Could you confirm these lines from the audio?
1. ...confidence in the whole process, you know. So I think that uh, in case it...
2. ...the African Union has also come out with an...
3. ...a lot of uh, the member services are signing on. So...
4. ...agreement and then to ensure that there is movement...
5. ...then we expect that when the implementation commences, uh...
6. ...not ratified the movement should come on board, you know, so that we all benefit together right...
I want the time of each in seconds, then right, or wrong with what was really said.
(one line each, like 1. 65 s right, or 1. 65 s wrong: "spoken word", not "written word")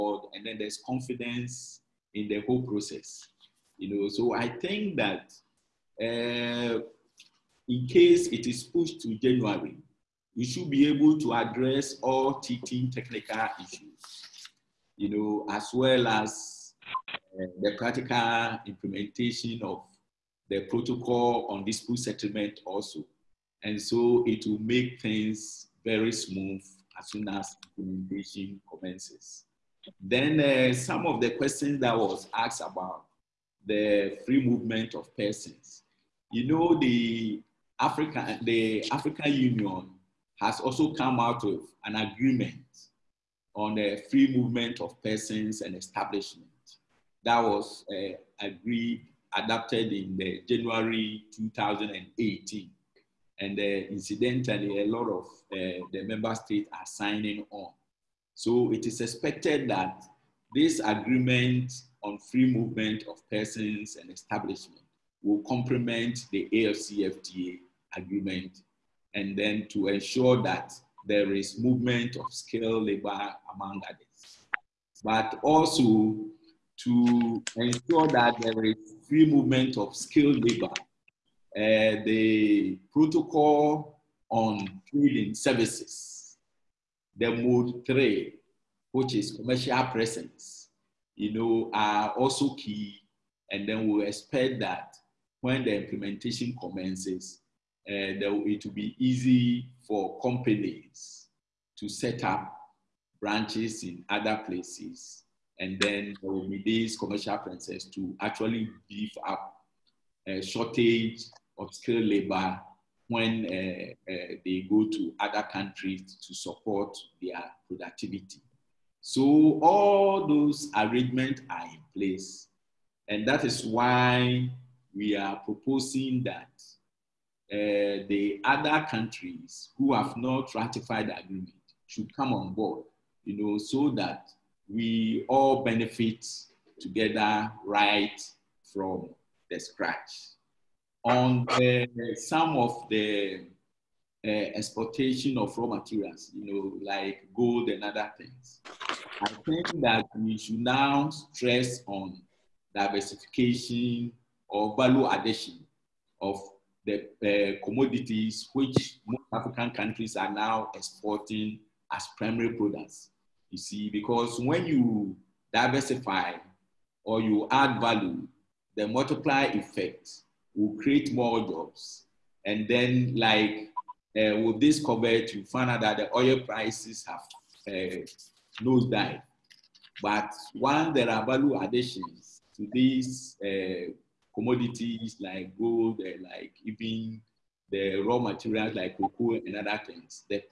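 1. 0 s right
2. 38 s right
3. 54 s wrong: "states", not "services"
4. 67 s right
5. 93 s right
6. 130 s wrong: "agreement", not "movement".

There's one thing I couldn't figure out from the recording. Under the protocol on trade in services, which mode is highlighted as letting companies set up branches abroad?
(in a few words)
Mode three.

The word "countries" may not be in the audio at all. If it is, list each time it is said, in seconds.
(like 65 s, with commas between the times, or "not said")
115 s, 128 s, 159 s.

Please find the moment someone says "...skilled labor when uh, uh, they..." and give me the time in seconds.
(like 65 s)
111 s.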